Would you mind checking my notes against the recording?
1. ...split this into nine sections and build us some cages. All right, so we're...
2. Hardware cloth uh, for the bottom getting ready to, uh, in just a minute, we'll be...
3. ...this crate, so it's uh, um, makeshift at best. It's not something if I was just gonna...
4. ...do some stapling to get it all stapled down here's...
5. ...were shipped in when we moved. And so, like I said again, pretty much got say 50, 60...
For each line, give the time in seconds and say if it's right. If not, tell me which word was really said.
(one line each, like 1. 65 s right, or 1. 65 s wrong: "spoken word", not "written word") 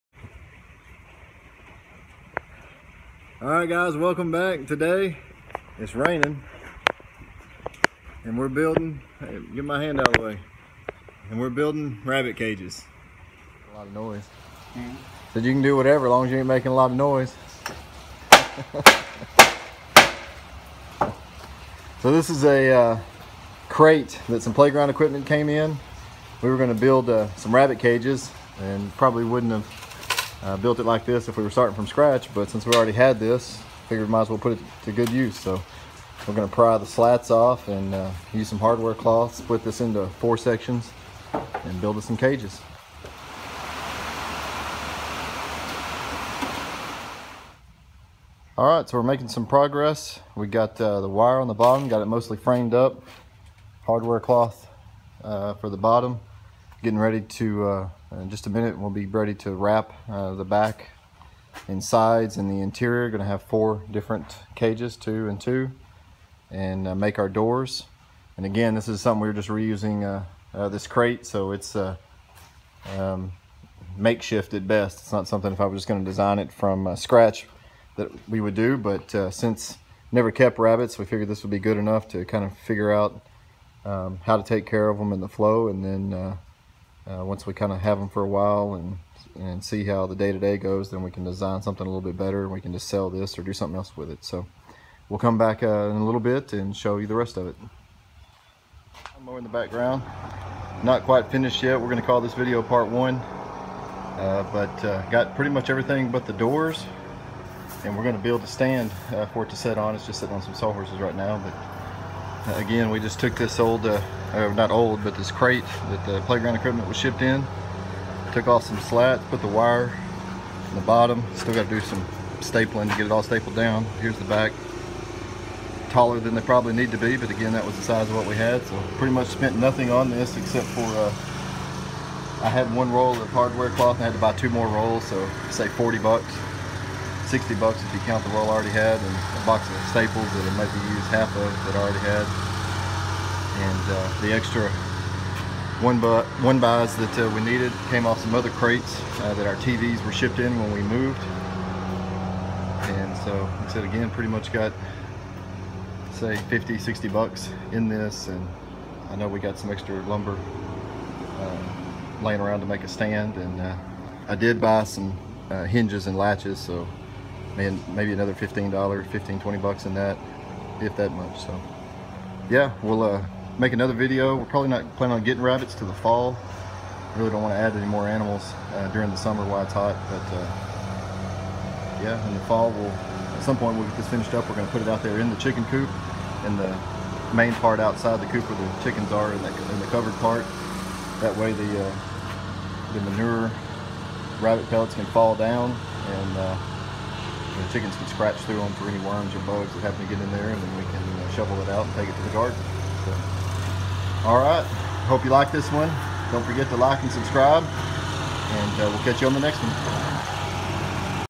1. 39 s wrong: "four", not "nine"
2. 53 s right
3. 70 s right
4. 121 s right
5. 150 s right.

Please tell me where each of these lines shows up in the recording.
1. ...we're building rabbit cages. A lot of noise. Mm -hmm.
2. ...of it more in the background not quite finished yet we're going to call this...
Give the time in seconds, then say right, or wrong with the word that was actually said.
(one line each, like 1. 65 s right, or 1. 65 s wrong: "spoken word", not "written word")
1. 11 s right
2. 97 s right.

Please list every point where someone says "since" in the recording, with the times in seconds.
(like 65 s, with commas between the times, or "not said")
32 s, 79 s.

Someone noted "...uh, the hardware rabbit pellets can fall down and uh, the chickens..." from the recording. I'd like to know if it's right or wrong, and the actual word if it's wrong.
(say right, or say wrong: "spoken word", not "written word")
wrong: "manure", not "hardware".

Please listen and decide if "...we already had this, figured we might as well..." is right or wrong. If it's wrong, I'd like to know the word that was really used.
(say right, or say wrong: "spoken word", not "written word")
right.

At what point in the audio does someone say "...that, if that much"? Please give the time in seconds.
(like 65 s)
169 s.